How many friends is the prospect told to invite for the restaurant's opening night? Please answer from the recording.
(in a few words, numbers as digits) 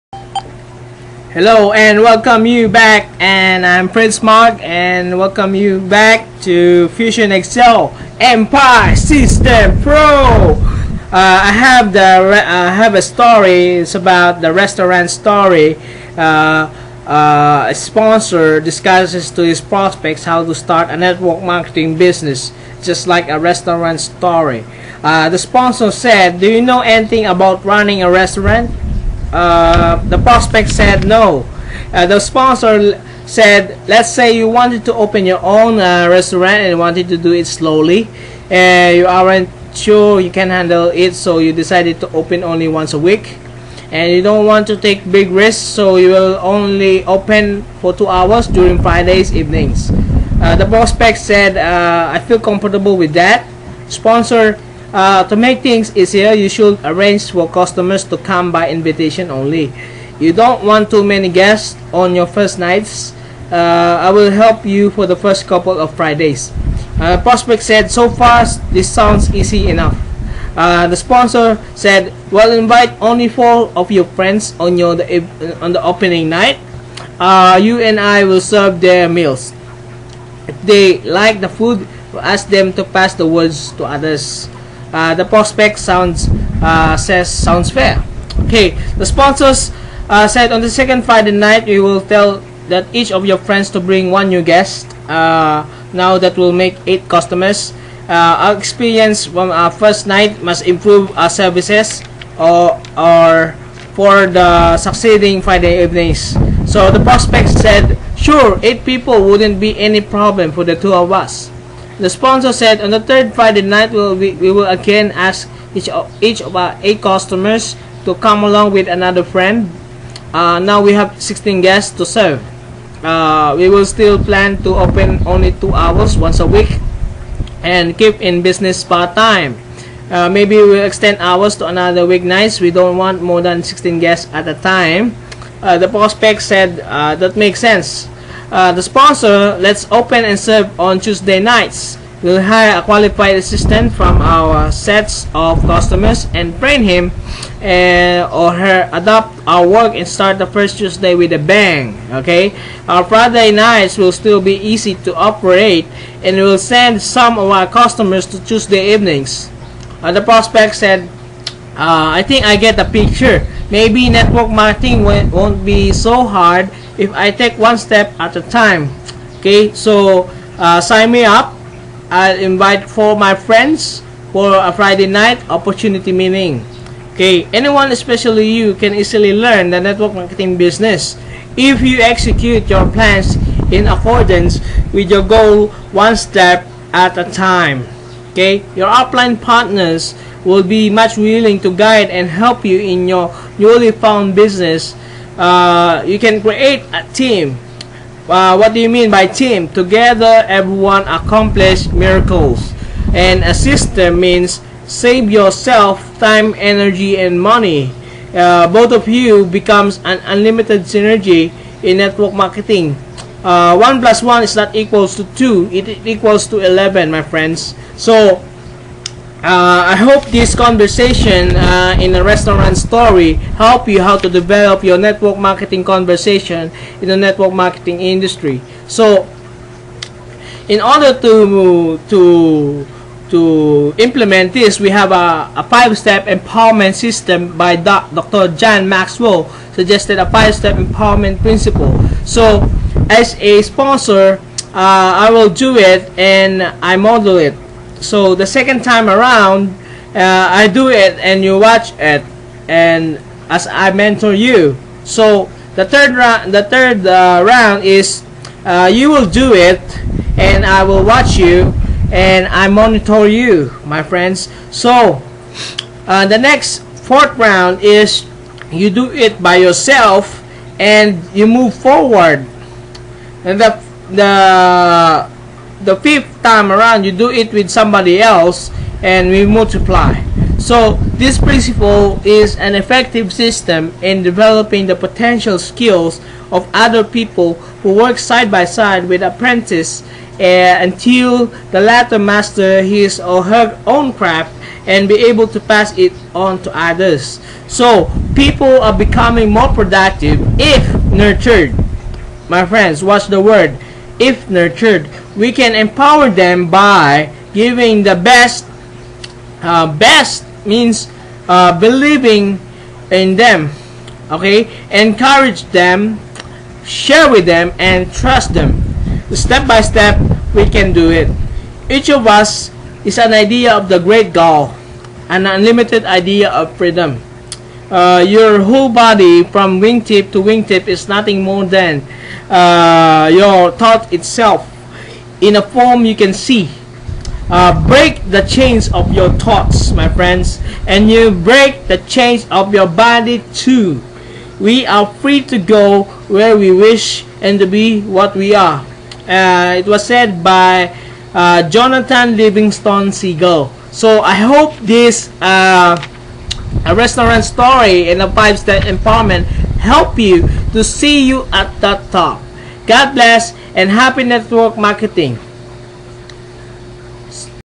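4.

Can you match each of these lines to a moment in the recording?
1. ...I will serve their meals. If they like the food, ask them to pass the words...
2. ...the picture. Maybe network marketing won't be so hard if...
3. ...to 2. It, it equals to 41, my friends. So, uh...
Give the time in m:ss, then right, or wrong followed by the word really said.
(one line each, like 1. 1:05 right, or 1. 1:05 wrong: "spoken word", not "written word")
1. 1:17 right
2. 2:42 right
3. 3:35 wrong: "11", not "41".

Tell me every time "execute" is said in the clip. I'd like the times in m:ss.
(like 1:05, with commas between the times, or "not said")
3:02.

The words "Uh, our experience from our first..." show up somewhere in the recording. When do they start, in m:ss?
1:38.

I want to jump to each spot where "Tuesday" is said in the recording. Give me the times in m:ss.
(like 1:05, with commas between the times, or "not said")
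2:20, 2:30, 2:38.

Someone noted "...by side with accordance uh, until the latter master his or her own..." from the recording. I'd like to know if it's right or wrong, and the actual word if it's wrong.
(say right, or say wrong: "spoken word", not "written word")
wrong: "apprentice", not "accordance".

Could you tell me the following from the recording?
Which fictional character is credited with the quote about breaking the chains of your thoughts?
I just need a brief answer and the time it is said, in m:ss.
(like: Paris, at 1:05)
Jonathan Livingston Seagull, at 5:51.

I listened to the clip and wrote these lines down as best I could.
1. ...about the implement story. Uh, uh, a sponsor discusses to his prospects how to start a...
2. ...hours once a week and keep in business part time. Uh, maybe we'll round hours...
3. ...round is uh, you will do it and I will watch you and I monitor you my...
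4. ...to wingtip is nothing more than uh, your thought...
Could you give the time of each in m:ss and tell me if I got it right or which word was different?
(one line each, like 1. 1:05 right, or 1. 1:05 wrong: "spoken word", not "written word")
1. 0:13 wrong: "restaurant", not "implement"
2. 2:05 wrong: "extend", not "round"
3. 4:17 right
4. 5:30 right.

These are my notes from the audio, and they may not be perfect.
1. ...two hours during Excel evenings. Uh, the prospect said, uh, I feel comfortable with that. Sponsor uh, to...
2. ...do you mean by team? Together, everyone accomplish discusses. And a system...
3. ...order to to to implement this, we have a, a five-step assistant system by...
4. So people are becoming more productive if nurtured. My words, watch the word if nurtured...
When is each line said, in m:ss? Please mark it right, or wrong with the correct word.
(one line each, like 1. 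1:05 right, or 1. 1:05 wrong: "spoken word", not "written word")
1. 0:47 wrong: "Fridays", not "Excel"
2. 3:18 wrong: "miracles", not "discusses"
3. 3:50 wrong: "empowerment", not "assistant"
4. 4:57 wrong: "friends", not "words".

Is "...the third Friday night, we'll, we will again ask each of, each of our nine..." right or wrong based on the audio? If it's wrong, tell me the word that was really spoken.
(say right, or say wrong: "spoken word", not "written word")
wrong: "eight", not "nine".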